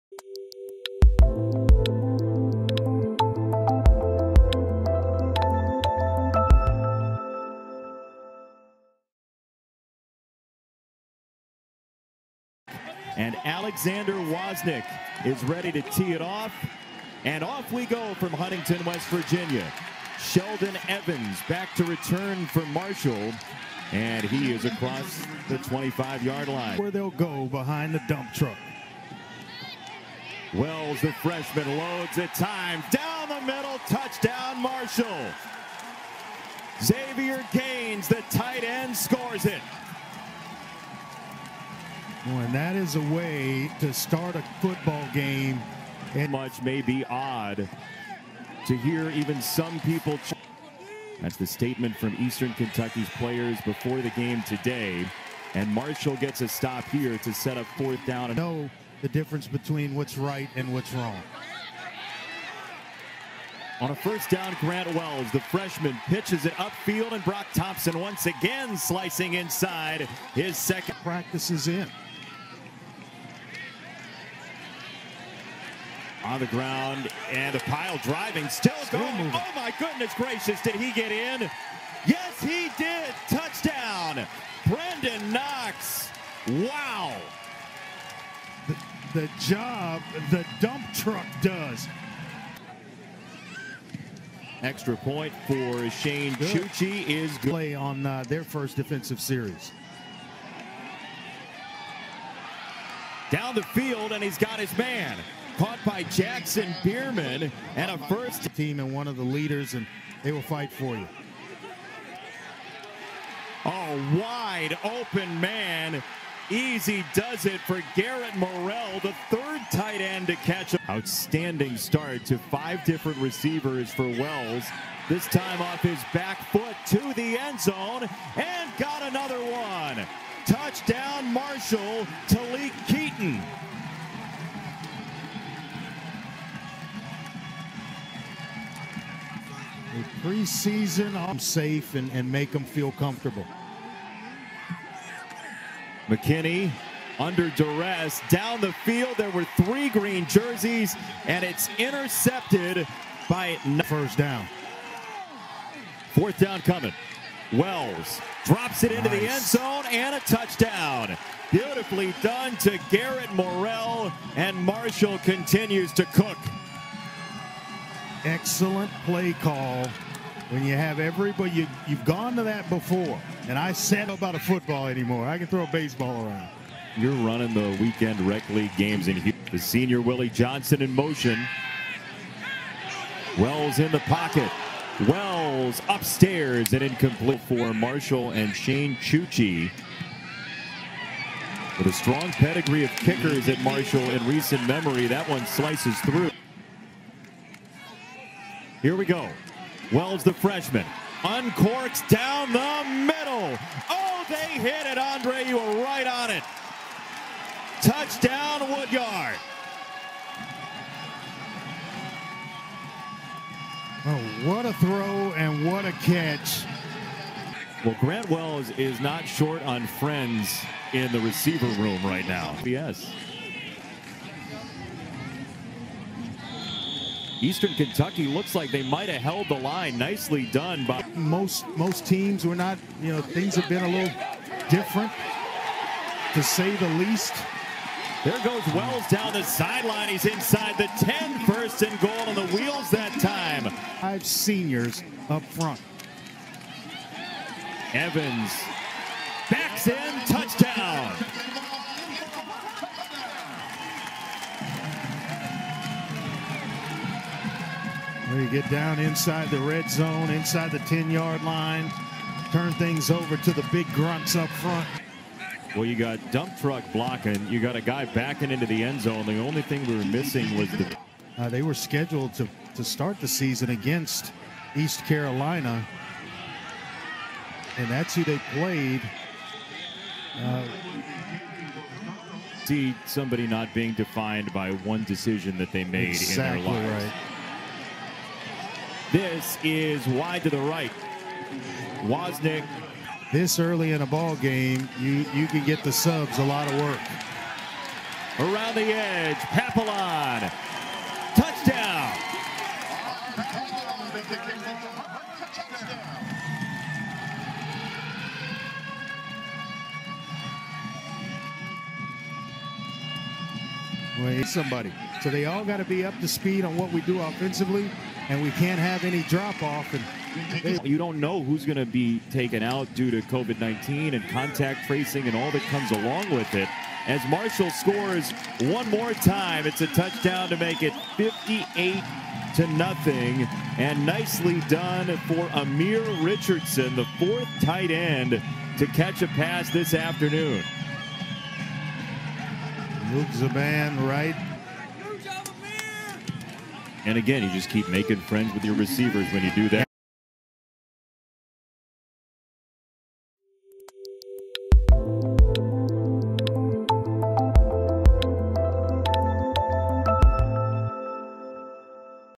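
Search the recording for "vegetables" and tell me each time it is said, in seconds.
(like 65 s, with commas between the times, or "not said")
not said.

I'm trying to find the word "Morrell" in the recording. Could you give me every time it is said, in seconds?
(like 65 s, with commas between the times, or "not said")
118 s, 163 s.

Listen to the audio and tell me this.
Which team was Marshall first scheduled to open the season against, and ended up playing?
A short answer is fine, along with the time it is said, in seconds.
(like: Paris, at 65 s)
East Carolina, at 274 s.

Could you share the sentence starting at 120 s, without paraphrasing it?
Outstanding start to five different receivers for Wells.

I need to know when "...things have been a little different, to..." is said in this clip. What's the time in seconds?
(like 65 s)
233 s.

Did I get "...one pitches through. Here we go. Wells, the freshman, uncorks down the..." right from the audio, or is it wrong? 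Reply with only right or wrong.
wrong.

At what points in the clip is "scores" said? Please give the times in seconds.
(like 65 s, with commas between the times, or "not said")
38 s, 327 s.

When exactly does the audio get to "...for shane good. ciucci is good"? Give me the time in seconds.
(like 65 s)
95 s.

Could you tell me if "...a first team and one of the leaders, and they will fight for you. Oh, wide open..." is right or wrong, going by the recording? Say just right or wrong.
right.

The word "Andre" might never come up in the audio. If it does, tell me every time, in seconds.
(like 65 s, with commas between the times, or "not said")
204 s.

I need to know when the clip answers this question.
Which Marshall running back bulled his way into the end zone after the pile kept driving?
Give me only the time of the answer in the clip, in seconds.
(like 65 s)
84 s.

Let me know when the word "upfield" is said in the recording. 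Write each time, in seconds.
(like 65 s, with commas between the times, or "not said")
66 s.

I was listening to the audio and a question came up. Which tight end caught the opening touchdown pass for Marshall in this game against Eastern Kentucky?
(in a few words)
Xavier Gaines.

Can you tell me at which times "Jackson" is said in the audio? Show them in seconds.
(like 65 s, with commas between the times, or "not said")
106 s.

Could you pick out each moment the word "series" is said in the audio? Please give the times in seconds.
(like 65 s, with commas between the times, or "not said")
99 s.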